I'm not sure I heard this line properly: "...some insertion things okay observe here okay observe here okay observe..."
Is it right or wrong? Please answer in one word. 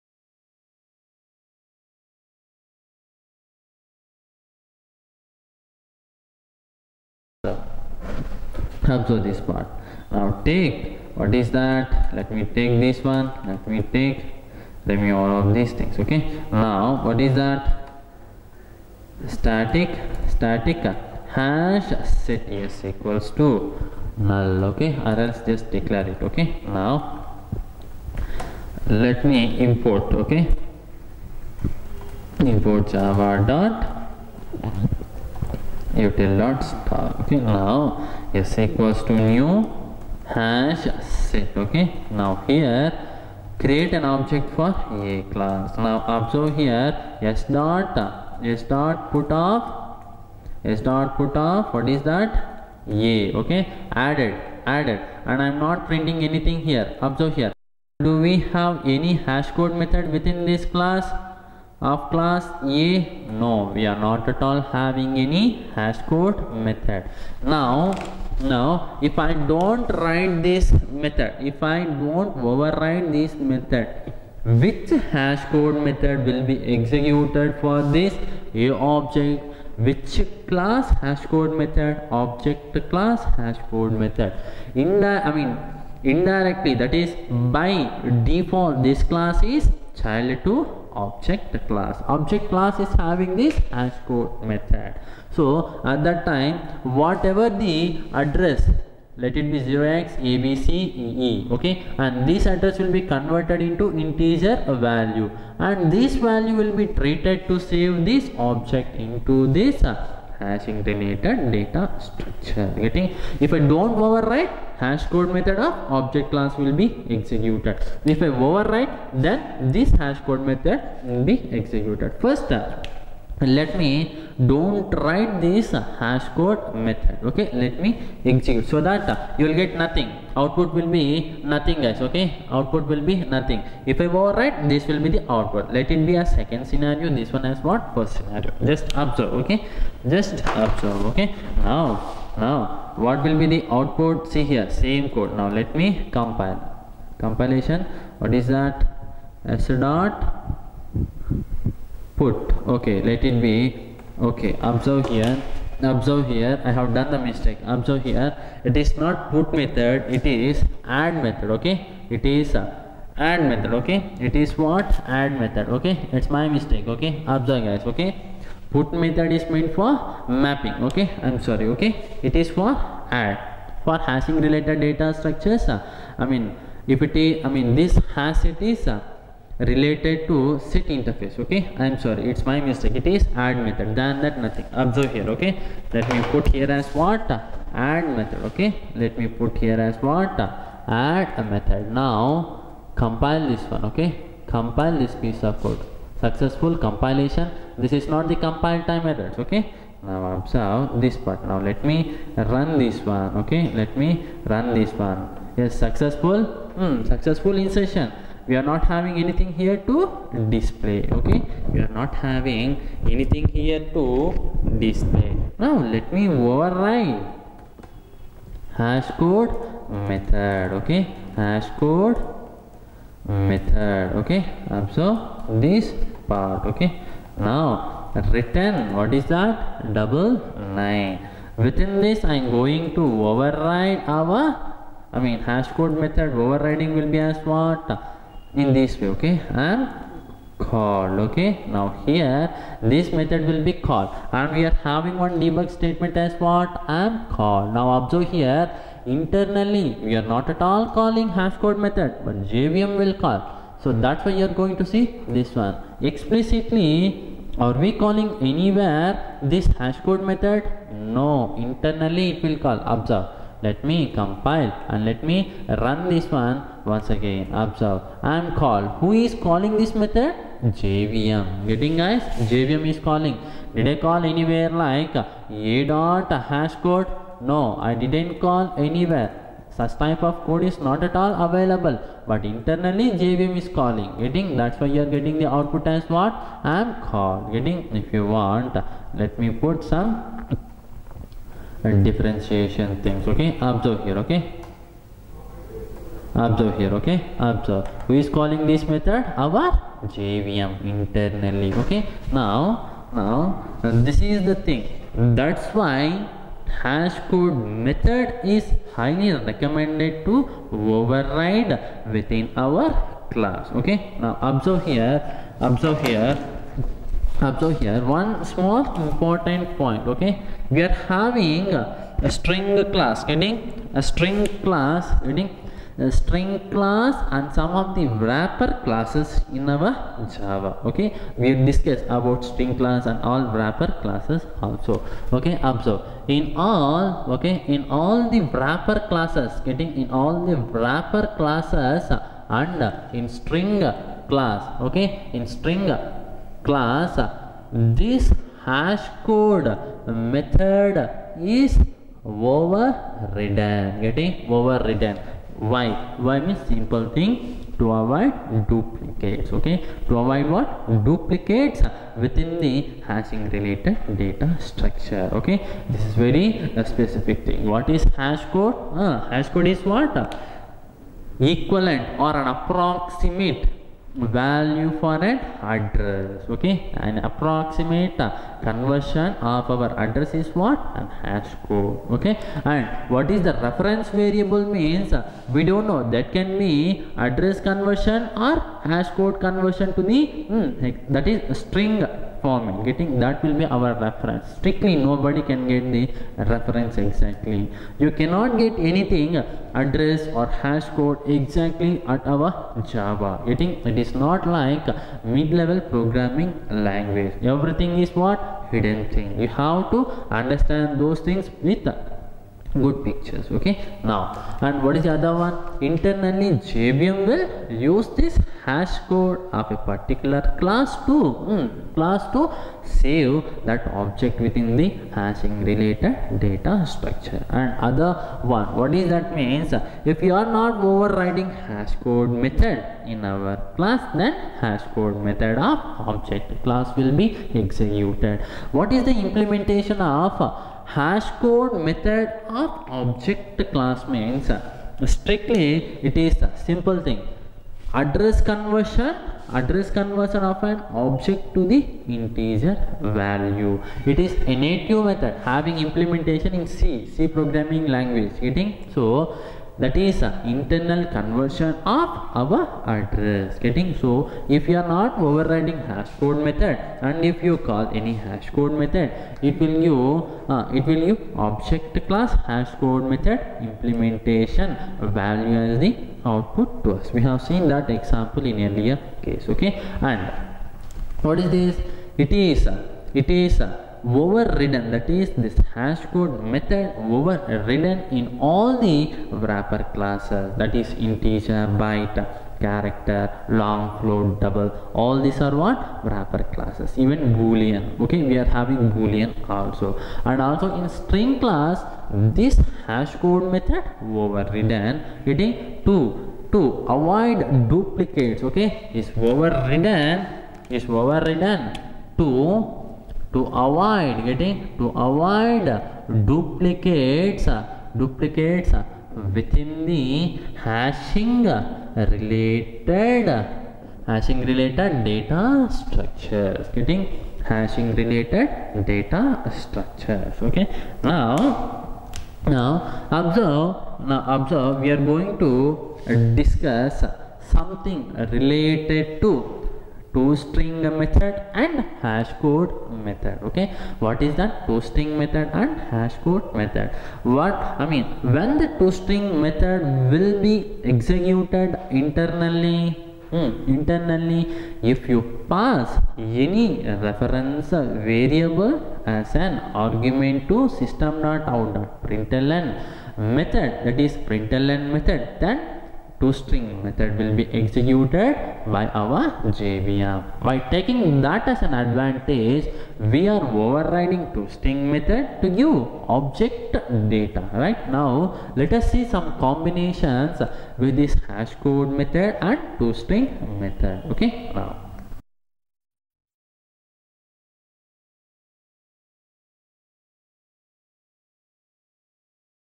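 wrong.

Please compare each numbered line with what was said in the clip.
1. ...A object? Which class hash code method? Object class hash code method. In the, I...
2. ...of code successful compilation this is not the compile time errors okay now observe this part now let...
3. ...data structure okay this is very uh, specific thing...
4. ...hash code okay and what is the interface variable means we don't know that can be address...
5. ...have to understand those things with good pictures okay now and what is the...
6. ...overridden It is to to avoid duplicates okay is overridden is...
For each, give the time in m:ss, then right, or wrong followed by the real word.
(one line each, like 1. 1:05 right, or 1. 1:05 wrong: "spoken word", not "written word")
1. 1:18 right
2. 3:15 right
3. 6:04 right
4. 6:21 wrong: "reference", not "interface"
5. 6:49 right
6. 8:24 right.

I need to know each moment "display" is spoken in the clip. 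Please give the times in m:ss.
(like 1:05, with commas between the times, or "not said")
3:30, 3:34.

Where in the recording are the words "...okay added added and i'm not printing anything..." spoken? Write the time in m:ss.
0:53.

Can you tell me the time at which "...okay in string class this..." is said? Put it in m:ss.
5:44.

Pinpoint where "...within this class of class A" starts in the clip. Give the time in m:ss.
1:00.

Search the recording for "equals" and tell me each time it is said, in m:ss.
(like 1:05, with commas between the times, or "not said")
0:22, 0:38.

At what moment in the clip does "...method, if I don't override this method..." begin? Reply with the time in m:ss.
1:10.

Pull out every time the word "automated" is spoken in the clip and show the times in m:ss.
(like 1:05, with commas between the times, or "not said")
not said.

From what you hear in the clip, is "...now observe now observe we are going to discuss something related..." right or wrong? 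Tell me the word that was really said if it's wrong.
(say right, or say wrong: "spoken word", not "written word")
right.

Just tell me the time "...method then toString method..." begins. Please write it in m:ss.
9:24.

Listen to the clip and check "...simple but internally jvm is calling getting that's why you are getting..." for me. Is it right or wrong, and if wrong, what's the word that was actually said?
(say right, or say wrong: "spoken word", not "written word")
wrong: "available", not "simple".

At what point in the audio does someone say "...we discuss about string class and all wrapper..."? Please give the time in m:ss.
5:31.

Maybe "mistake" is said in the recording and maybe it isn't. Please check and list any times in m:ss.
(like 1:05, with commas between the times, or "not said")
2:37, 2:46, 3:02.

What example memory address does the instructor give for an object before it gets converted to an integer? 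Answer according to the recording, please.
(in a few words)
0x abc ee.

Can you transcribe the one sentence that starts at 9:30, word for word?
By taking that as an advantage, we are overriding toString method to give object data.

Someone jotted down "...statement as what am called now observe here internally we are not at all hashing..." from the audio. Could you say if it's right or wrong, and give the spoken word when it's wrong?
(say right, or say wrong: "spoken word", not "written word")
wrong: "calling", not "hashing".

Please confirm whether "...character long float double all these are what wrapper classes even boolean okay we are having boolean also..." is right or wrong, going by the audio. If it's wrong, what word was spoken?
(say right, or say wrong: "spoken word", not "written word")
right.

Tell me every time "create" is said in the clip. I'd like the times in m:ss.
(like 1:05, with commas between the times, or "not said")
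0:43.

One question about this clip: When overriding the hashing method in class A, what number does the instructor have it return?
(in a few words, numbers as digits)
99.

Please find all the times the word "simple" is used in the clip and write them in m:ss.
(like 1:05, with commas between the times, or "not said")
5:56, 7:26.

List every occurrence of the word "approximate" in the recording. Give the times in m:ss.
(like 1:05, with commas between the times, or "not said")
6:12, 6:17.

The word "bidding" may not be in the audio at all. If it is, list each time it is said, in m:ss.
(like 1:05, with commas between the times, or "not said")
not said.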